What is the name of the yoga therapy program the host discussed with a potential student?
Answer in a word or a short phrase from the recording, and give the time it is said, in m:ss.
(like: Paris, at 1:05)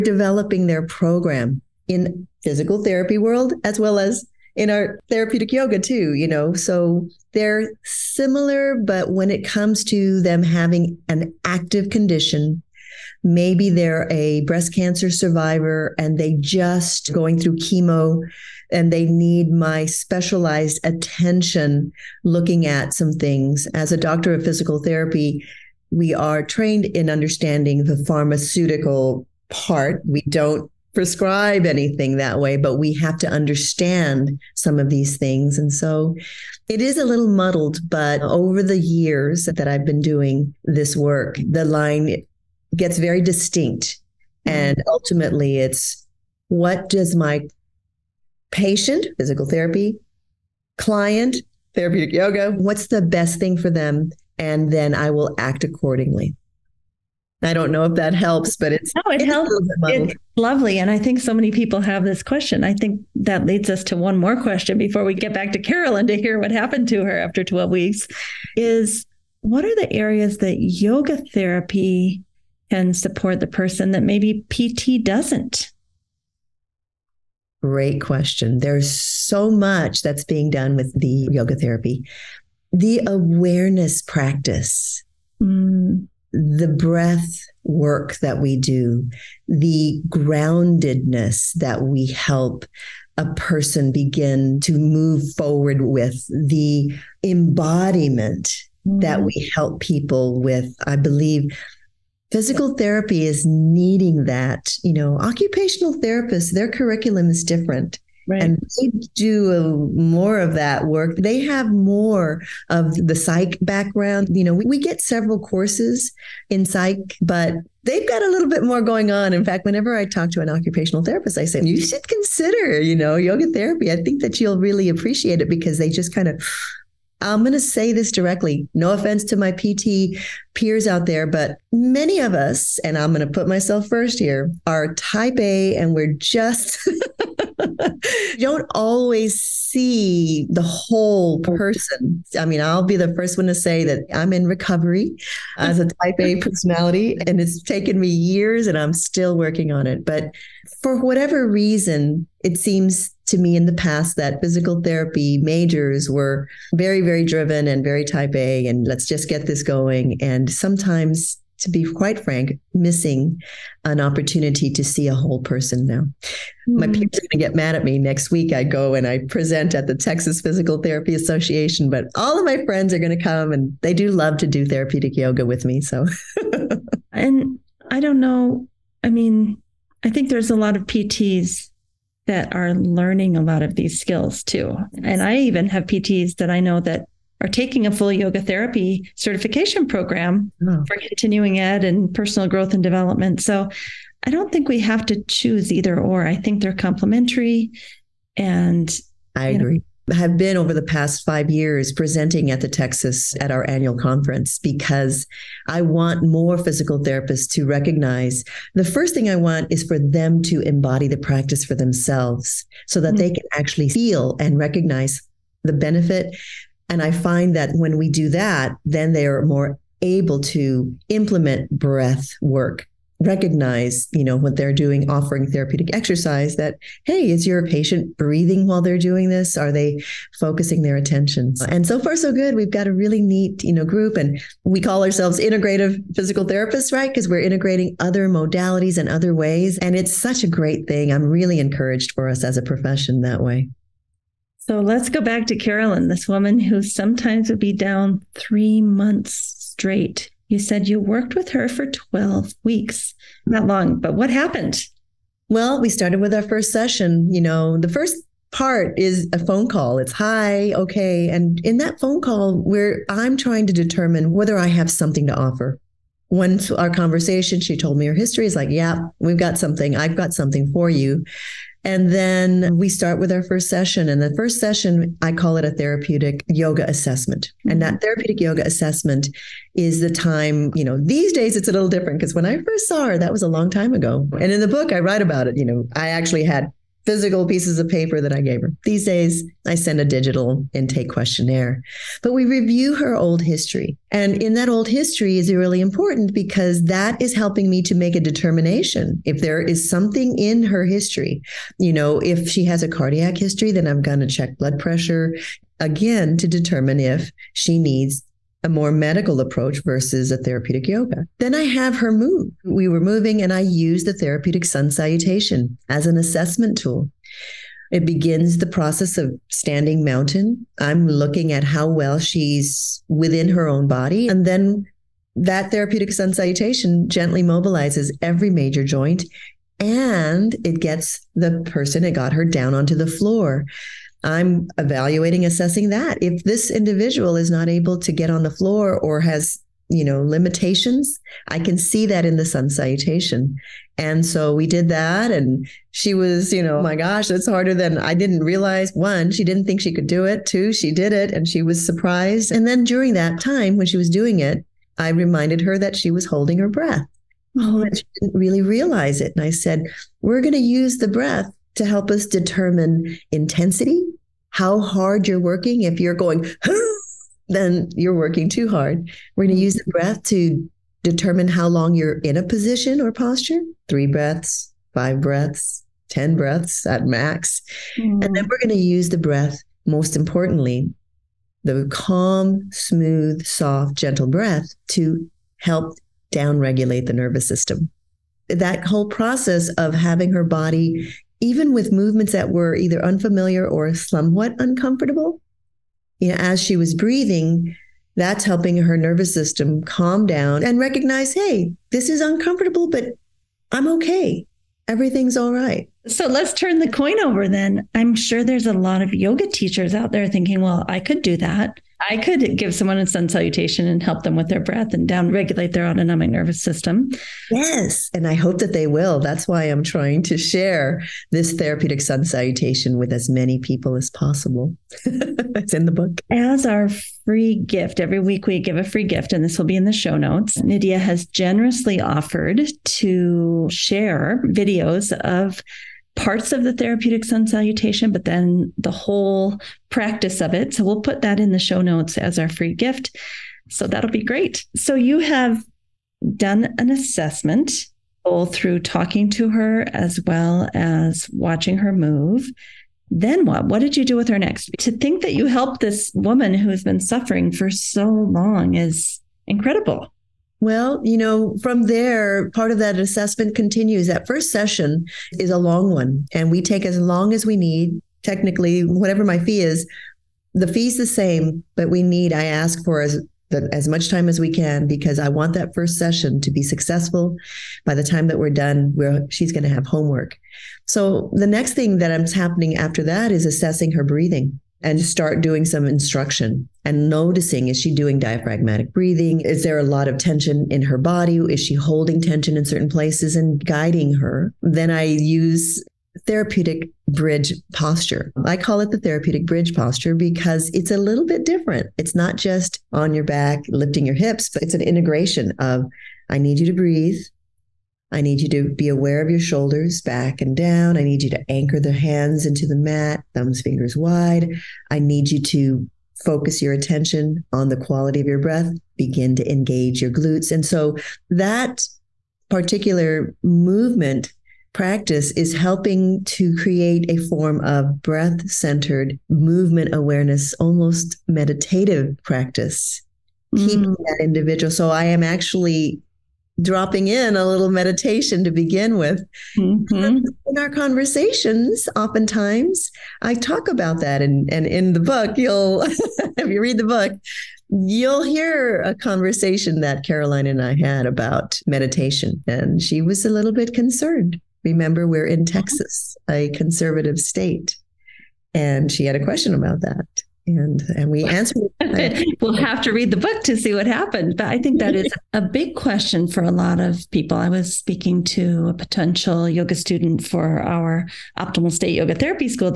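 Optimal State, at 9:31.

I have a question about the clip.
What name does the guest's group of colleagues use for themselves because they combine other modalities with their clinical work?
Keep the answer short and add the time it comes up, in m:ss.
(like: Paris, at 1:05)
integrative physical therapists, at 3:55.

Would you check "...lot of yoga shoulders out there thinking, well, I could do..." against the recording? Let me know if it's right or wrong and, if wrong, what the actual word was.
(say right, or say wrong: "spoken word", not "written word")
wrong: "teachers", not "shoulders".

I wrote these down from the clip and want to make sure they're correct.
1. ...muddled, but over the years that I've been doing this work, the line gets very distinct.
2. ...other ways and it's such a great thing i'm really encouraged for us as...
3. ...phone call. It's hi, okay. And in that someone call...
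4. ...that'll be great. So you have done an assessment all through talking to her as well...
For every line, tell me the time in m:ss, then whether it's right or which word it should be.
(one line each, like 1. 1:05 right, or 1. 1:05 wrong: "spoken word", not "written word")
1. 0:37 right
2. 3:59 right
3. 4:19 wrong: "phone", not "someone"
4. 7:23 right.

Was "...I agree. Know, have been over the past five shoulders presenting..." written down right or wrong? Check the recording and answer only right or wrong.
wrong.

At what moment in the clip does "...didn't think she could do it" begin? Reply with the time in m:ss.
5:49.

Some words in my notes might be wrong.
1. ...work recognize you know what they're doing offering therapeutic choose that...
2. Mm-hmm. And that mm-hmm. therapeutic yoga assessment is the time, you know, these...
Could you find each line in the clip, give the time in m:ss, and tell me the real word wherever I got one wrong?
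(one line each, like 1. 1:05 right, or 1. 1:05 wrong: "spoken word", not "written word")
1. 3:42 wrong: "exercise", not "choose"
2. 4:37 right.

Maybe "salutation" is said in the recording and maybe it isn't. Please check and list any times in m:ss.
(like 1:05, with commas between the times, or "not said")
5:14, 5:26, 5:42, 6:53, 7:02, 7:17.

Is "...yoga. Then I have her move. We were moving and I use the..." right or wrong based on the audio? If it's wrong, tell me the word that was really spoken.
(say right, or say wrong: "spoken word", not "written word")
right.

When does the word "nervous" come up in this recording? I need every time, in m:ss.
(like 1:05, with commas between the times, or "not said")
6:27, 6:38, 6:56.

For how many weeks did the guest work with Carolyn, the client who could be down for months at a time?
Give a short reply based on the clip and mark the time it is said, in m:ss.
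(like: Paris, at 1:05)
12, at 4:11.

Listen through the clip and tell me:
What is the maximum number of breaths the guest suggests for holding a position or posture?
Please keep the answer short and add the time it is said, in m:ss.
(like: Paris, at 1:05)
10, at 6:16.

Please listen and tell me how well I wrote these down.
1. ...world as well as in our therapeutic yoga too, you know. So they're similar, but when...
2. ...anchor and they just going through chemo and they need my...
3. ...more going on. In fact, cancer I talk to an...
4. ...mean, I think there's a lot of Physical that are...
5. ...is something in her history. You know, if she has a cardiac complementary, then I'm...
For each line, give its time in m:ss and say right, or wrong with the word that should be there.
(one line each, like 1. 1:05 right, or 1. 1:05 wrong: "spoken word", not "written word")
1. 0:03 right
2. 0:15 wrong: "survivor", not "anchor"
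3. 1:58 wrong: "whenever", not "cancer"
4. 2:59 wrong: "PTs", not "Physical"
5. 4:59 wrong: "history", not "complementary".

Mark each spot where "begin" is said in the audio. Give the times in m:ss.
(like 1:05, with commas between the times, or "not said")
1:33, 5:18, 8:38, 8:58.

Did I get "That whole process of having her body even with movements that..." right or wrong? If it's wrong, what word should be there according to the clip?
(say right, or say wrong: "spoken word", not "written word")
right.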